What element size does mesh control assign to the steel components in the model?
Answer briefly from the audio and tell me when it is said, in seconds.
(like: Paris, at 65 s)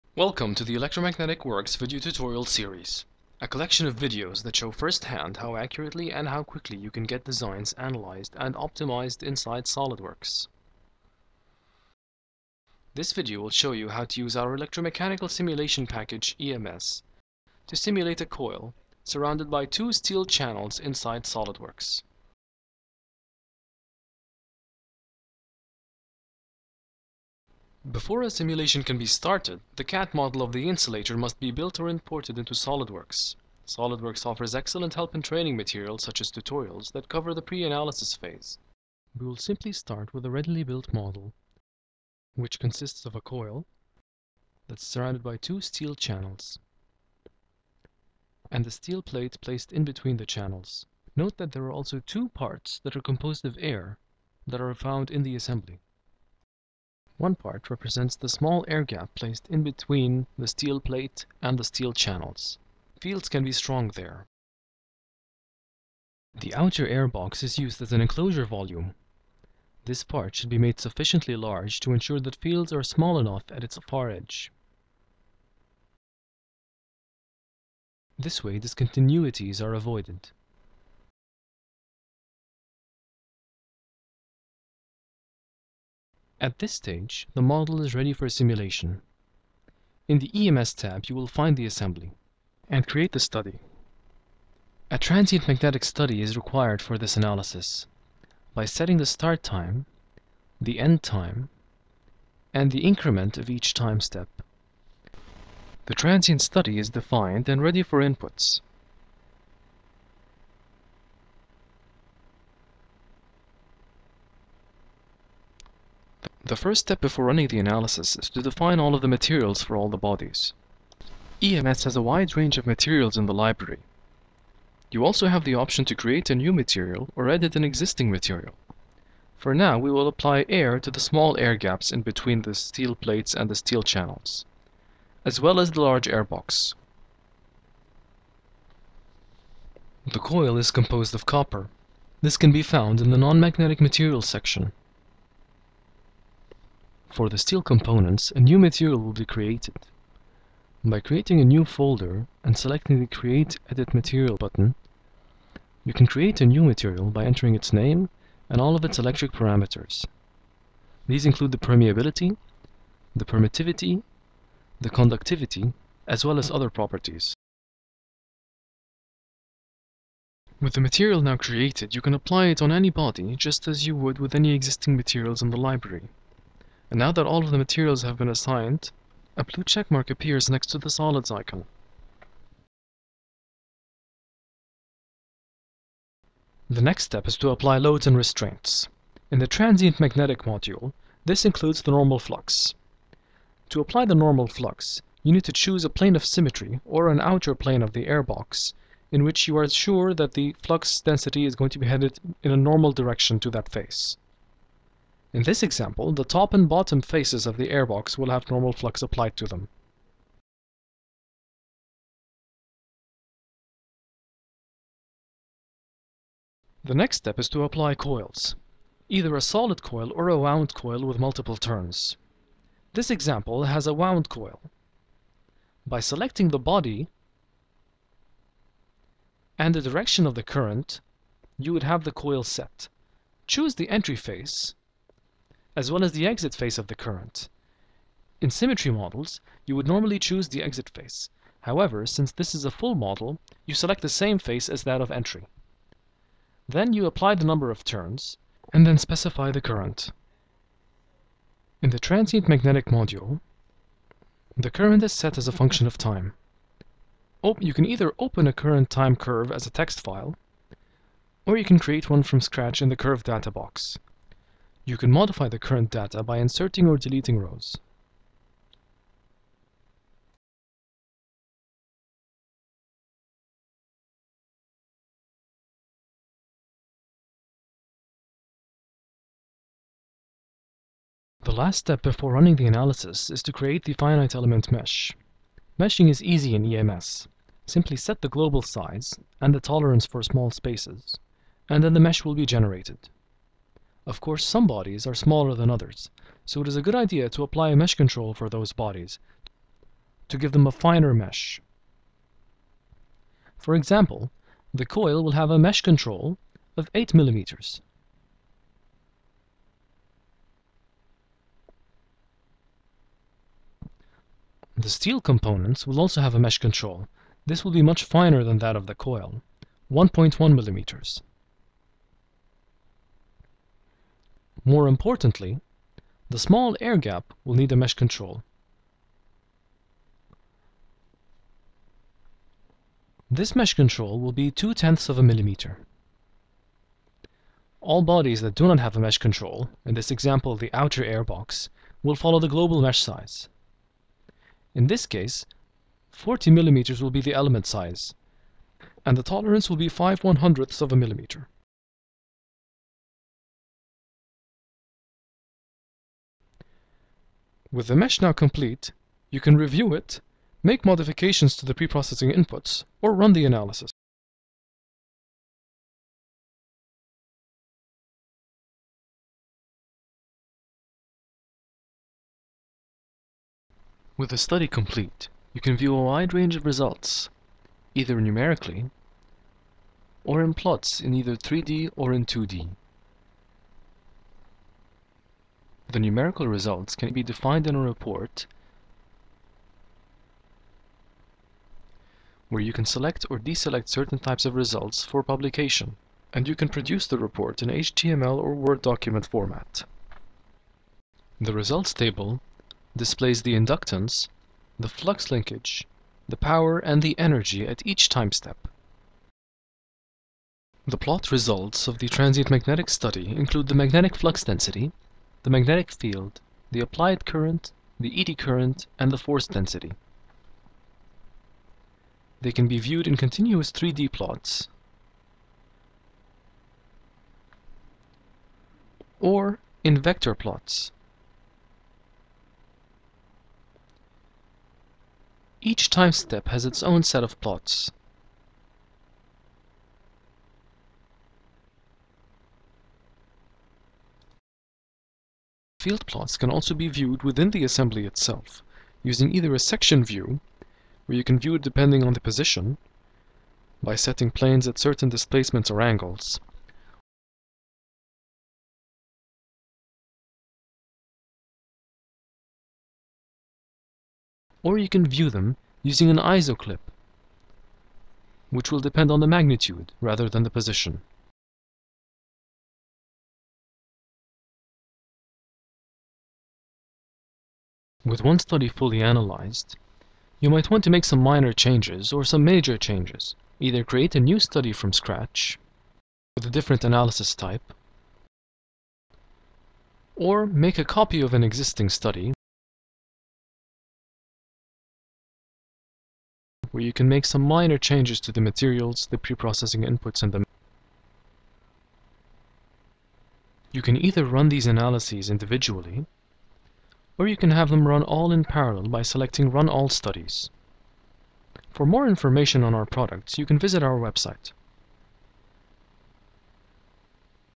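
1.1 millimeters, at 319 s.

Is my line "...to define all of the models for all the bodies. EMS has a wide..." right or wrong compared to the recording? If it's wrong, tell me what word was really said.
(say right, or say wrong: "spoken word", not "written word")
wrong: "materials", not "models".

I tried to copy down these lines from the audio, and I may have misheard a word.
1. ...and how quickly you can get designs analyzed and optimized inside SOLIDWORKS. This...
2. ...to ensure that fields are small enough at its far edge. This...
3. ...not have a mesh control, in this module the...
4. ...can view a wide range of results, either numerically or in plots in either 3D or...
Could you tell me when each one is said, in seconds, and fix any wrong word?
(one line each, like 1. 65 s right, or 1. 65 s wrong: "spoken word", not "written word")
1. 6 s right
2. 71 s right
3. 338 s wrong: "example", not "module"
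4. 375 s right.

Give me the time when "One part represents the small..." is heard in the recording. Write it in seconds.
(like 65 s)
57 s.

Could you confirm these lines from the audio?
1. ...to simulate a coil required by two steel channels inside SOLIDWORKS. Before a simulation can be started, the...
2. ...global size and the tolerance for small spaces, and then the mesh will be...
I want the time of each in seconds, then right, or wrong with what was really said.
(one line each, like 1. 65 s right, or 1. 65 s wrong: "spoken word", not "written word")
1. 17 s wrong: "surrounded", not "required"
2. 288 s right.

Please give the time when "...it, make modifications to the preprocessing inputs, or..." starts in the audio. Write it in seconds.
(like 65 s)
359 s.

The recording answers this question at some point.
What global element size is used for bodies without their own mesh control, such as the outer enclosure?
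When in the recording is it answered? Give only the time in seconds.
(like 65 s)
346 s.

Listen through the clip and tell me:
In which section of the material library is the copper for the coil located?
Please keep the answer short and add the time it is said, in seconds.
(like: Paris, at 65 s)
Non-magnetic materials, at 143 s.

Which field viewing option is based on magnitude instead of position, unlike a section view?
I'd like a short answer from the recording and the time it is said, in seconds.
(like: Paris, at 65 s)
Isoclip, at 466 s.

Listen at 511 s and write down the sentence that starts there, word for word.
For more information on our products, you can visit our website.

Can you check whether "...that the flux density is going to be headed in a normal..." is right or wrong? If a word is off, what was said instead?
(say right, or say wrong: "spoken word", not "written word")
right.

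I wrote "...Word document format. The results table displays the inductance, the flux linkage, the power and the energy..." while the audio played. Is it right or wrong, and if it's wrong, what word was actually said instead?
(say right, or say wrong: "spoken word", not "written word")
right.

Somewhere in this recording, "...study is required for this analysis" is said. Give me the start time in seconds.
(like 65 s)
95 s.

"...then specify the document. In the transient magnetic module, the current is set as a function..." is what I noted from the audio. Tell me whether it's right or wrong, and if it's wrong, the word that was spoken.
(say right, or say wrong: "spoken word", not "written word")
wrong: "current", not "document".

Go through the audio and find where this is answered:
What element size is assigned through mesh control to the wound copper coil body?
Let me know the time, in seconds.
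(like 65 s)
306 s.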